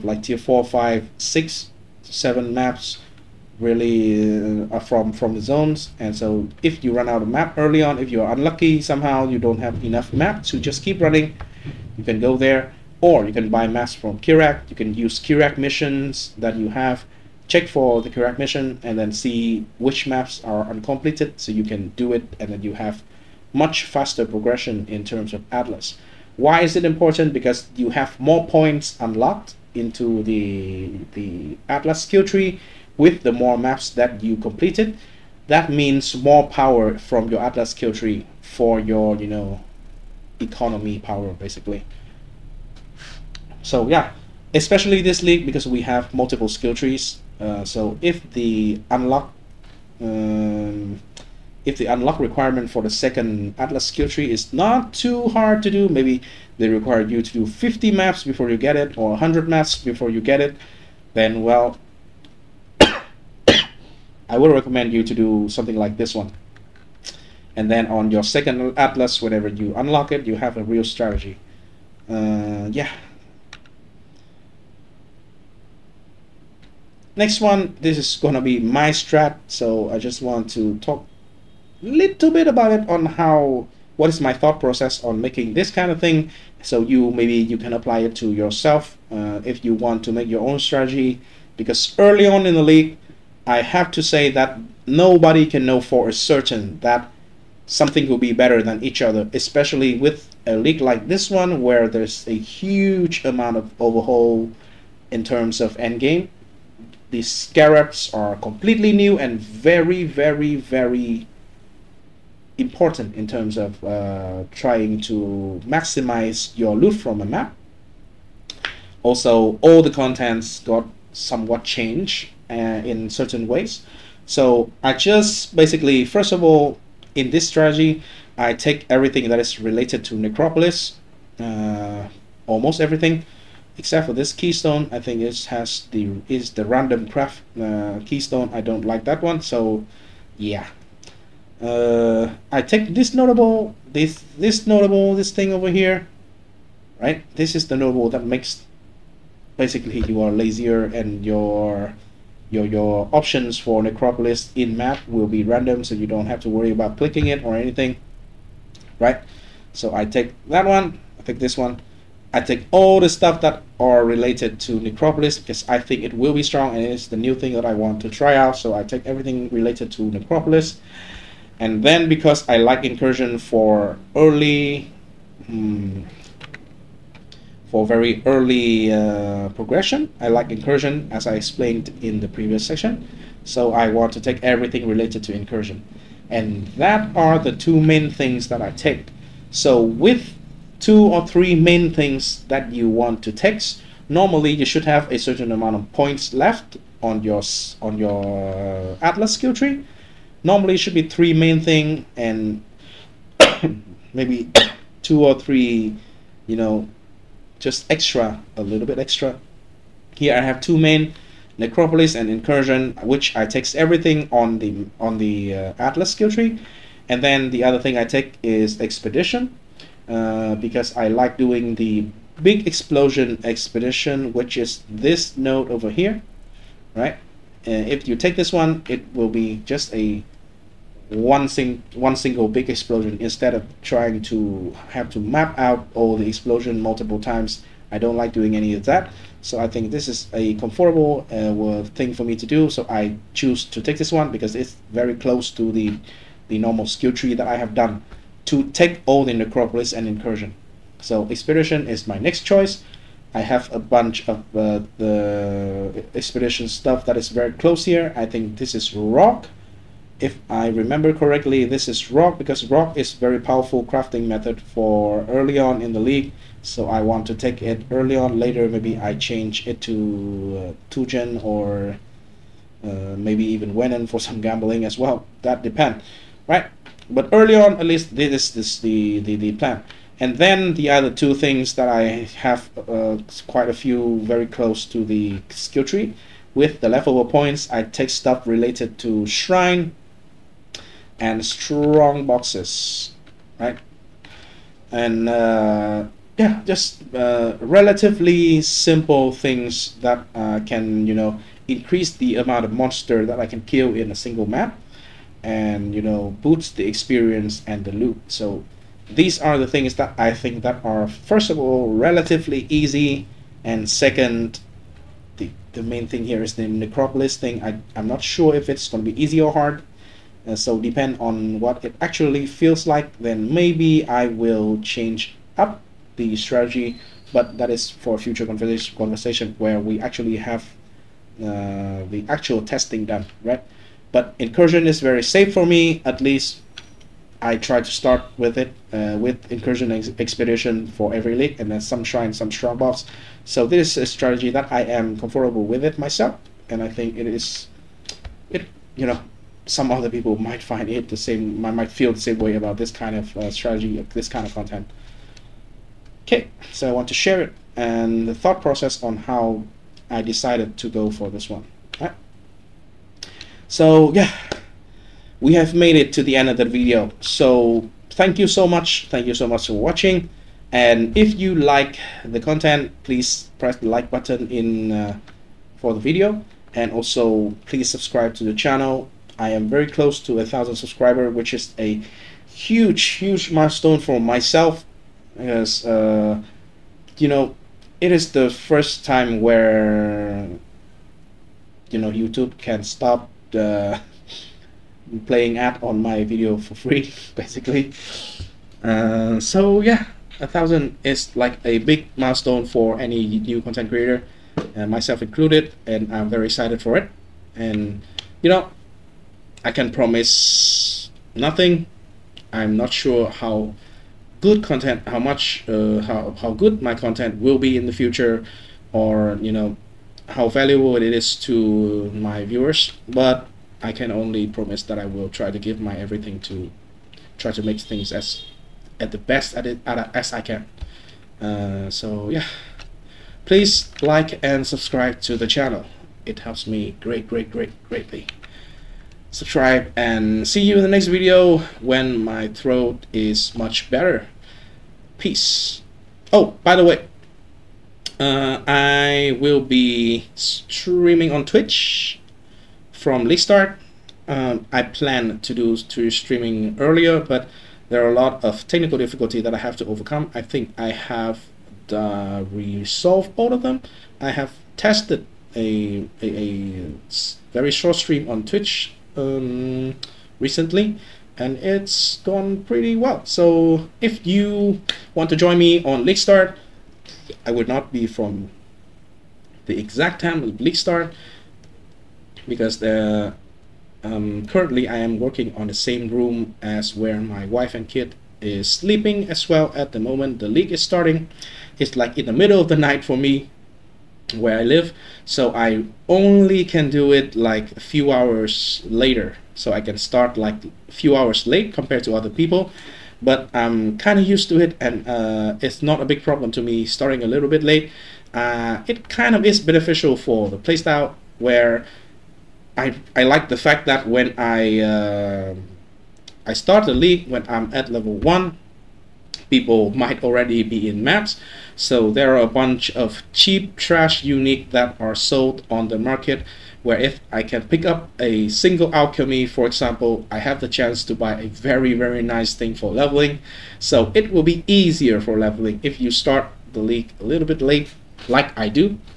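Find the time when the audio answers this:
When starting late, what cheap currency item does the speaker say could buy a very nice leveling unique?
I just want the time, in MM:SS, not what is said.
08:48.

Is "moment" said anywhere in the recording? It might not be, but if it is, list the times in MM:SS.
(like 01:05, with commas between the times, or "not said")
08:10.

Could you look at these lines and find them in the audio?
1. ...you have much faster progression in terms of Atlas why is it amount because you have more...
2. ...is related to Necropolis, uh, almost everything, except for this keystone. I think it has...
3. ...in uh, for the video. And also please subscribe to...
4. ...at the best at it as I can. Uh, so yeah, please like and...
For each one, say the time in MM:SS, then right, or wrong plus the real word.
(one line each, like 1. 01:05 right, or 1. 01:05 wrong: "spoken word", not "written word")
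1. 00:22 wrong: "important", not "amount"
2. 02:09 right
3. 06:14 right
4. 07:08 right.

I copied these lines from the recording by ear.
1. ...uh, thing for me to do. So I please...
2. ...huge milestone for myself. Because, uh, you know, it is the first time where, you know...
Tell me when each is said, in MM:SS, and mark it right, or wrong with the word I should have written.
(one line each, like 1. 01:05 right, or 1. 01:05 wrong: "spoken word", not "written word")
1. 04:01 wrong: "choose", not "please"
2. 06:23 right.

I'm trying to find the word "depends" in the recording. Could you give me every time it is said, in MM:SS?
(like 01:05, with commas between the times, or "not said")
04:35, 05:20.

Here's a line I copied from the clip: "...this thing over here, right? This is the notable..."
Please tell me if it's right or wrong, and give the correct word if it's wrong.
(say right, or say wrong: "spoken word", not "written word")
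right.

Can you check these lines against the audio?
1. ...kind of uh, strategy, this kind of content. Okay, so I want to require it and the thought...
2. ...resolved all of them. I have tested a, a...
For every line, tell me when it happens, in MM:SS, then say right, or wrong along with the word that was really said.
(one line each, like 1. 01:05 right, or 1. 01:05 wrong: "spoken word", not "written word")
1. 05:52 wrong: "share", not "require"
2. 07:42 right.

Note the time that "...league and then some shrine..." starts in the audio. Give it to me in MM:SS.
05:41.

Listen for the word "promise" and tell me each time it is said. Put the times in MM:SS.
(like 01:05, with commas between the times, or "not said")
06:49, 07:04.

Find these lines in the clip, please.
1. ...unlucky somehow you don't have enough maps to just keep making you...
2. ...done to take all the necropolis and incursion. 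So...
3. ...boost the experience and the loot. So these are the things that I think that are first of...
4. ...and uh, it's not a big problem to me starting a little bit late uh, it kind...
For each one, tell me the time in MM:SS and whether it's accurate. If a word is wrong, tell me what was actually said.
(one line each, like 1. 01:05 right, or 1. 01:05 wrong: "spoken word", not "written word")
1. 00:08 wrong: "running", not "making"
2. 04:07 right
3. 05:06 right
4. 08:24 right.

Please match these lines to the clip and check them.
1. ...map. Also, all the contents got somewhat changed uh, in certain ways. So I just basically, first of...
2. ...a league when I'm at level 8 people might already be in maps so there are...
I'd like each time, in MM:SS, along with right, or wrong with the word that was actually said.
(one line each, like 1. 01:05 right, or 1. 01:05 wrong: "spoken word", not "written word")
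1. 01:57 right
2. 08:36 wrong: "1", not "8".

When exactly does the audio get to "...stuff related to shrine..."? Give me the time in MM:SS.
04:48.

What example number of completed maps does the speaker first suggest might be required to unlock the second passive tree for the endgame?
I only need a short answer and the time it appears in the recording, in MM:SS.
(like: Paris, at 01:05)
50, at 00:57.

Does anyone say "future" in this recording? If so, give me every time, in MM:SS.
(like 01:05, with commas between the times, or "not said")
05:28, 06:57.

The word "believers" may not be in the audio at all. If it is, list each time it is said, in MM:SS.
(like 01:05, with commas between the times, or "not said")
not said.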